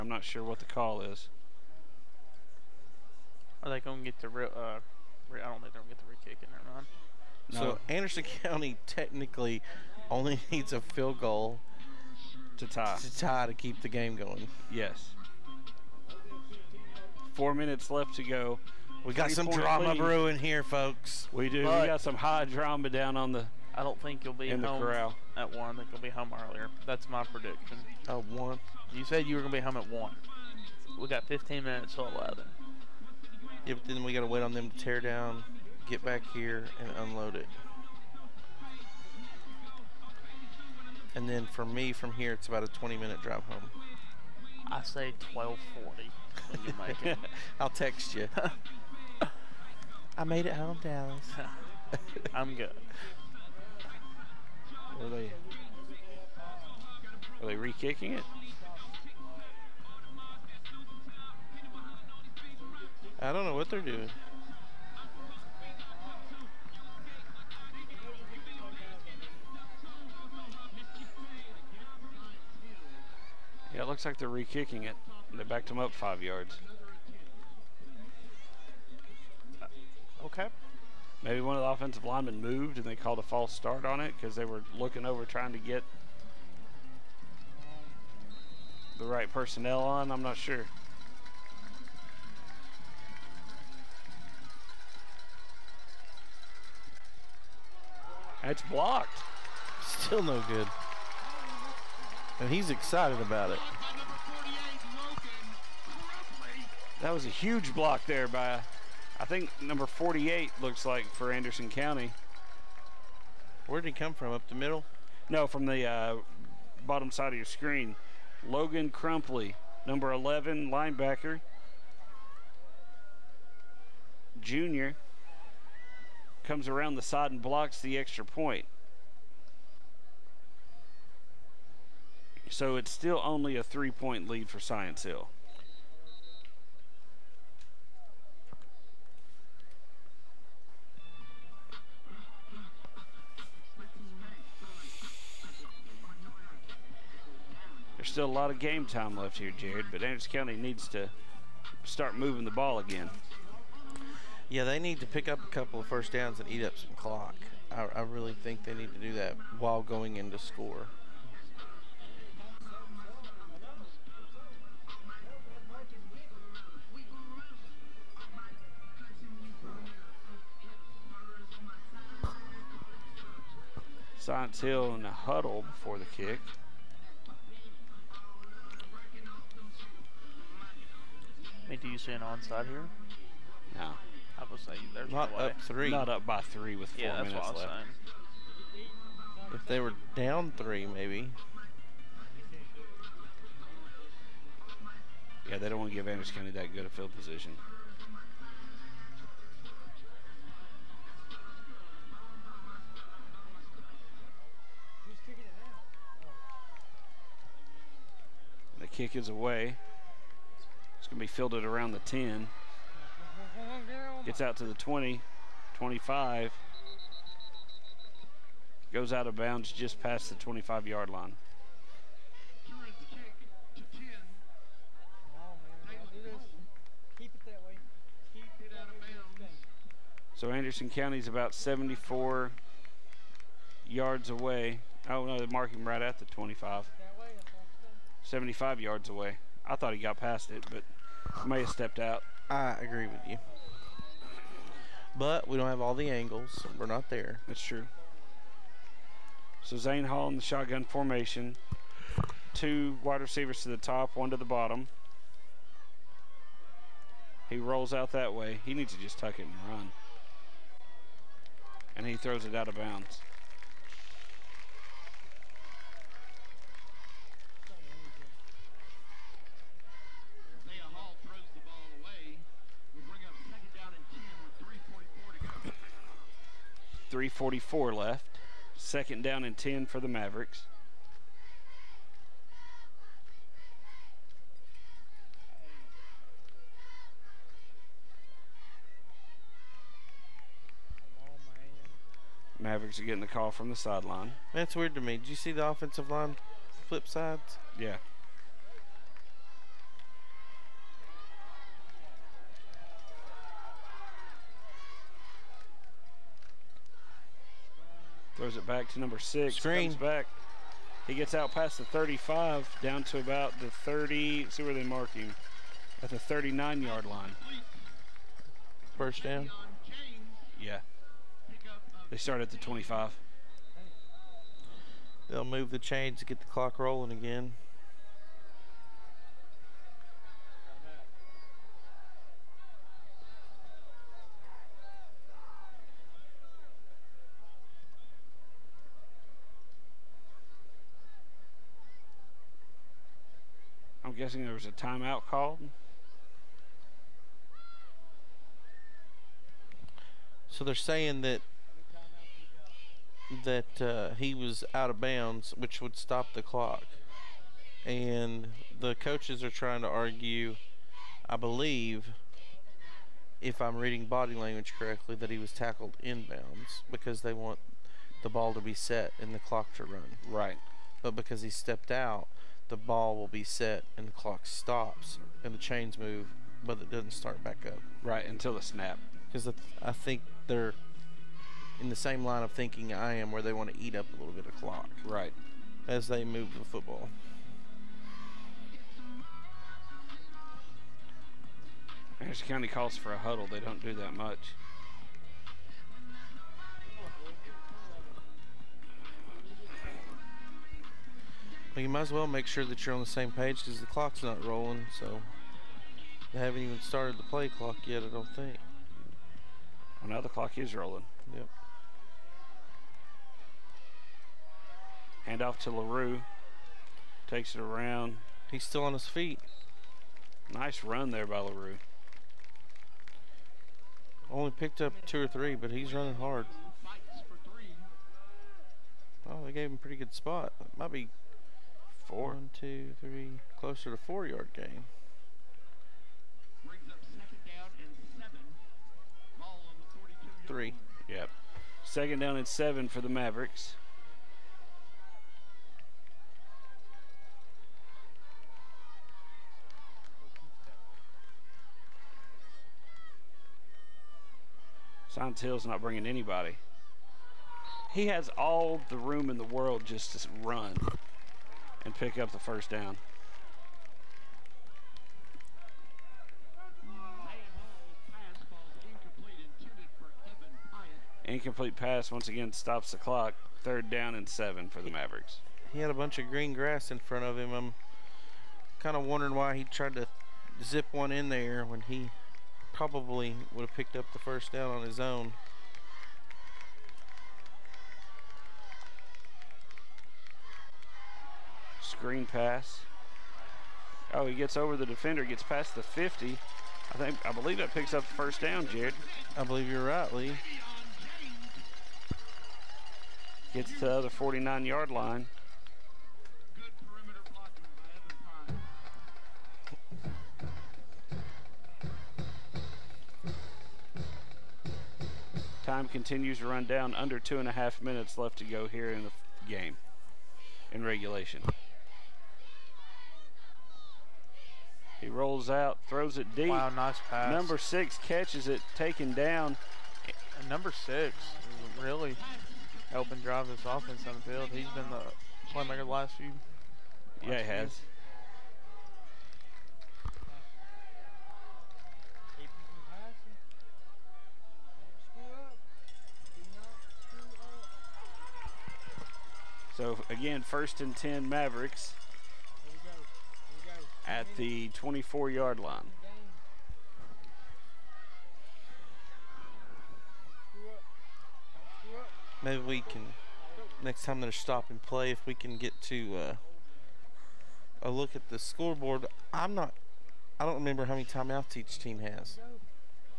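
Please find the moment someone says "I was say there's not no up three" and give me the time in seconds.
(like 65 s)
184 s.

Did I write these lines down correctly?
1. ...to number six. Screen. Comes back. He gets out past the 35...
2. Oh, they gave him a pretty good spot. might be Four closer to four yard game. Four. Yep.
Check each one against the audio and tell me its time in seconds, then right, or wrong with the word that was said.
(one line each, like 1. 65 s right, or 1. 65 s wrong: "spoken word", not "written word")
1. 308 s right
2. 429 s wrong: "Three", not "Four".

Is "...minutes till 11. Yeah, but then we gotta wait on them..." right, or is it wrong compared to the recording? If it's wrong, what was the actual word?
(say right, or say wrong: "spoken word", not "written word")
right.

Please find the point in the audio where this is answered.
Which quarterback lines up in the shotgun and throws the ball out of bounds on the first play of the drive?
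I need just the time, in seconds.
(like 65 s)
249 s.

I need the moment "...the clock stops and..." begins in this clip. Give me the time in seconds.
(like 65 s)
374 s.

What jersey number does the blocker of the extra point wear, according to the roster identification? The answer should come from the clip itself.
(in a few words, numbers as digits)
11.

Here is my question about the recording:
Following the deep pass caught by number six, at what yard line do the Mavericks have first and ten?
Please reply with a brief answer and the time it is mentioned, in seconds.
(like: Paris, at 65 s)
24, at 554 s.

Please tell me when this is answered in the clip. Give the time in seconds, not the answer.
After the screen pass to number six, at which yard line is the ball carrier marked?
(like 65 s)
316 s.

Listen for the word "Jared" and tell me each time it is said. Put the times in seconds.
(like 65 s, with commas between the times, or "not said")
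149 s, 498 s.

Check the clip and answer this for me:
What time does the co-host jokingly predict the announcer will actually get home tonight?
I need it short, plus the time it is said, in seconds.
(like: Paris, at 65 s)
12:40, at 45 s.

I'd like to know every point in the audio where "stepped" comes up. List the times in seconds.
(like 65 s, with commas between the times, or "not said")
241 s, 371 s.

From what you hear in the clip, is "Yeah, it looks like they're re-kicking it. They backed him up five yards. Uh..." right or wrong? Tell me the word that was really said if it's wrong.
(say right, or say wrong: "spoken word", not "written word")
right.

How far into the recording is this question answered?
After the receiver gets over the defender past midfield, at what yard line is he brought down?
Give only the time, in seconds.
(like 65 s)
504 s.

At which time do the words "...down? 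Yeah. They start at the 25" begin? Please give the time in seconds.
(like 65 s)
319 s.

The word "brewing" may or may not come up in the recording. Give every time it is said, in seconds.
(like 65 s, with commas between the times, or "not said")
19 s.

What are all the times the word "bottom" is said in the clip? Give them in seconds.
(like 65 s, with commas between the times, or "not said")
116 s, 254 s.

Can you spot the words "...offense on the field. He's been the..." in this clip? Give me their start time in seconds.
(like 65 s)
533 s.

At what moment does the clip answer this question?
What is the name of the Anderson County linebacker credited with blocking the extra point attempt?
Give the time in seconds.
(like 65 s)
118 s.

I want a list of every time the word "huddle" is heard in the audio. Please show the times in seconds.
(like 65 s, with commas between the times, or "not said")
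175 s, 393 s.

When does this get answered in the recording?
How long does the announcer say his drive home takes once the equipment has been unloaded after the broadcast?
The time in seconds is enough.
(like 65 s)
42 s.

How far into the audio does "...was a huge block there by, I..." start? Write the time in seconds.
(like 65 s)
107 s.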